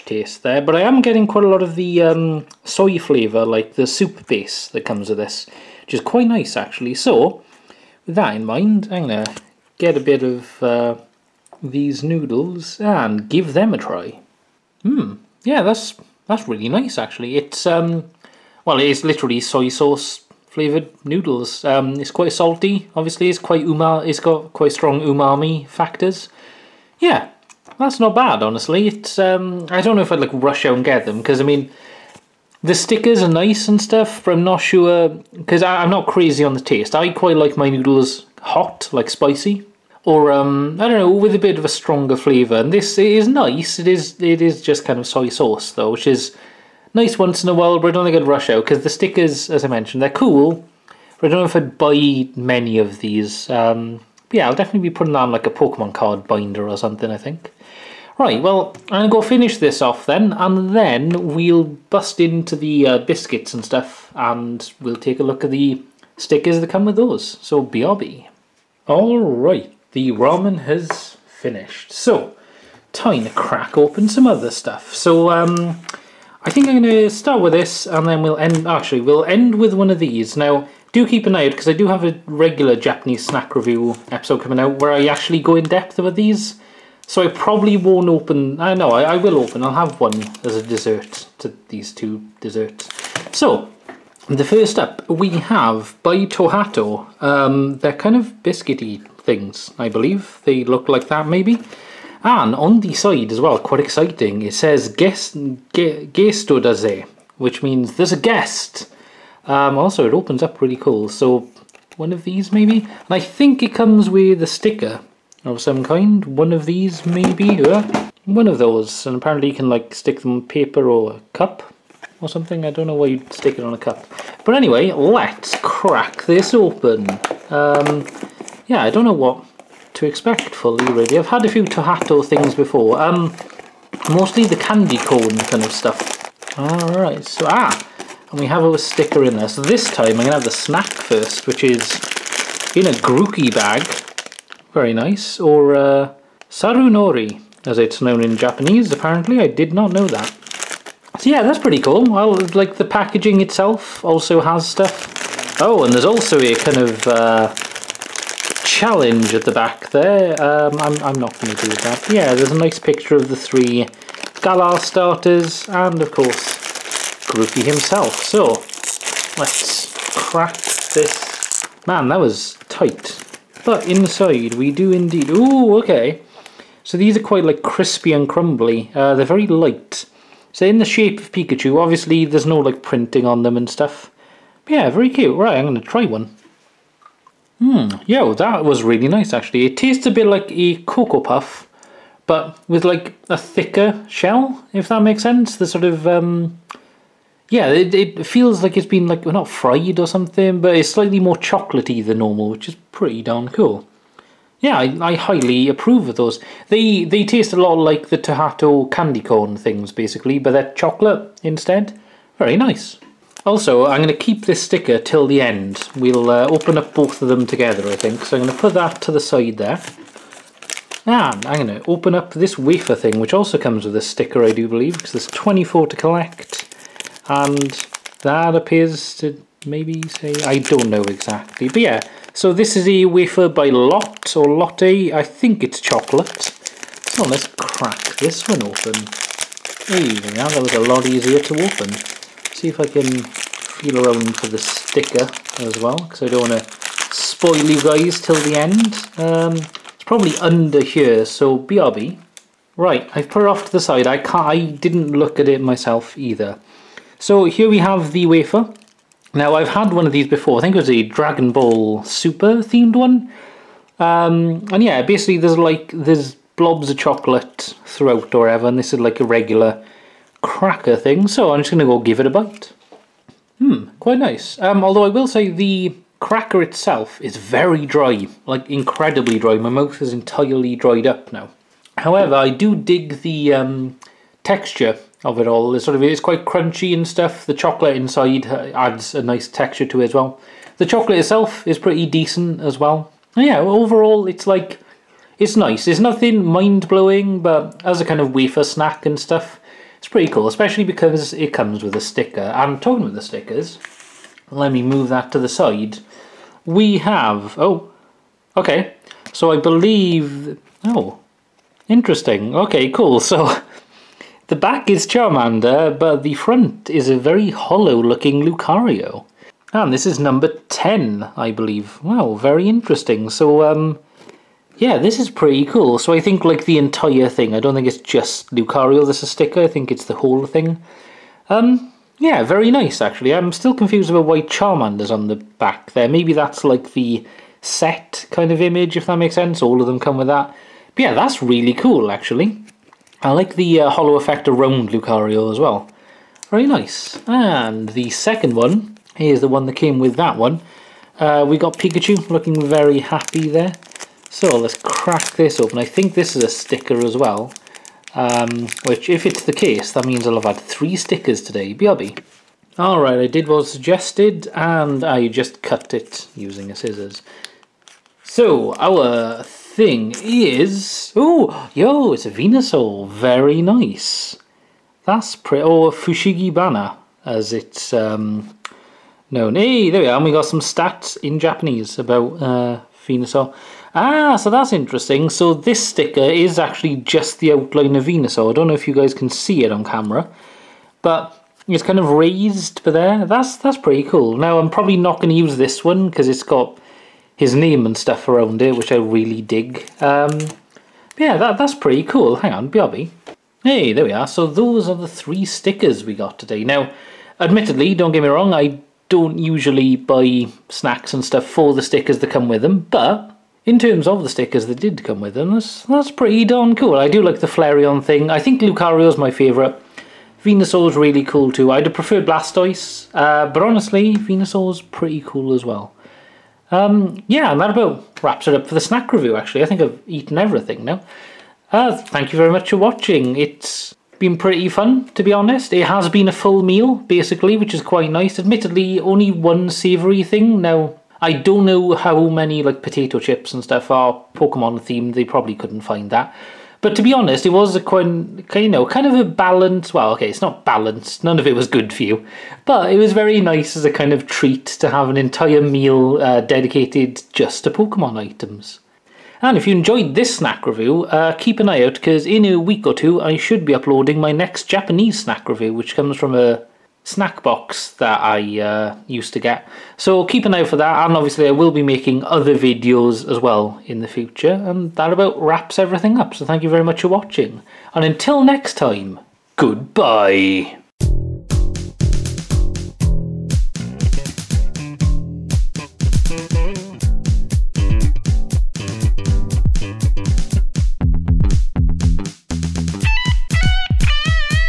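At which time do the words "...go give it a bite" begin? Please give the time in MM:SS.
04:31.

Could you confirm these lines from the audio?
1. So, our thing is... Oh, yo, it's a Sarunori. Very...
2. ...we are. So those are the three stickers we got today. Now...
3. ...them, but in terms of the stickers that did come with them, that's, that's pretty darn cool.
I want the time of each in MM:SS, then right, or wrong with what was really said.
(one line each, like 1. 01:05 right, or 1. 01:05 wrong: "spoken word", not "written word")
1. 06:08 wrong: "Venusaur", not "Sarunori"
2. 06:44 right
3. 06:52 right.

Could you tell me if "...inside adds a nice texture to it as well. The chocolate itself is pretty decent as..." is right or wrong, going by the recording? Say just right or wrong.
right.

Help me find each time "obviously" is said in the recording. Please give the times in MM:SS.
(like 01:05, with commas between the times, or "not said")
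00:22, 03:01, 07:51.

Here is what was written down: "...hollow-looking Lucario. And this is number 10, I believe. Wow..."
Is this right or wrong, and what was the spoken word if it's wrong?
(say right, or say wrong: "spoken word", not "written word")
right.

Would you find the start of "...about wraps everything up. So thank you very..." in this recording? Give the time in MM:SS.
07:55.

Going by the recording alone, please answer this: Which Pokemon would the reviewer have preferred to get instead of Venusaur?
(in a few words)
Blastoise.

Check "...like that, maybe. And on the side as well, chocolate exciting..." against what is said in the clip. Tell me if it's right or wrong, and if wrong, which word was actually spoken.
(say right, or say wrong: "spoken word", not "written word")
wrong: "quite", not "chocolate".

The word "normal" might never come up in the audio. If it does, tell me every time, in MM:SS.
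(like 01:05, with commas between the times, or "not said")
03:22.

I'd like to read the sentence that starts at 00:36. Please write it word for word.
I quite like my noodles hot, like spicy, or um, I don't know, with a bit of a stronger flavour.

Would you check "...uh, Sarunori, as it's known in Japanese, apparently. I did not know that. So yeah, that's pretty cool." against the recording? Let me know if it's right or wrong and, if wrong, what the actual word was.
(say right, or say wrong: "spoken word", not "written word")
right.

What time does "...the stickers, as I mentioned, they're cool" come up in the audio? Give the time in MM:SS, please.
00:48.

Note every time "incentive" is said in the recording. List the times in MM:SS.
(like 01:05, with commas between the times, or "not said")
not said.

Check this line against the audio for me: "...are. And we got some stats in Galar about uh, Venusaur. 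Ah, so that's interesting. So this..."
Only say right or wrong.
wrong.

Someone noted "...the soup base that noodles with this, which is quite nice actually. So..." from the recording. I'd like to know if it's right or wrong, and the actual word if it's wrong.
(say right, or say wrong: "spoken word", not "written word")
wrong: "comes", not "noodles".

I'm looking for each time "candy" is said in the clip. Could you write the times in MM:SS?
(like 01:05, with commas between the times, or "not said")
02:14, 03:28.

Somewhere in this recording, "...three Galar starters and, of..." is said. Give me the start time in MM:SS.
02:43.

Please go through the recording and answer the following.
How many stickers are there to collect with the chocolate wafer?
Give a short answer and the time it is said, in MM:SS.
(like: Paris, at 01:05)
24, at 03:45.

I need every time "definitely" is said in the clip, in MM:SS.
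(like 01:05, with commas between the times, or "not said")
00:54.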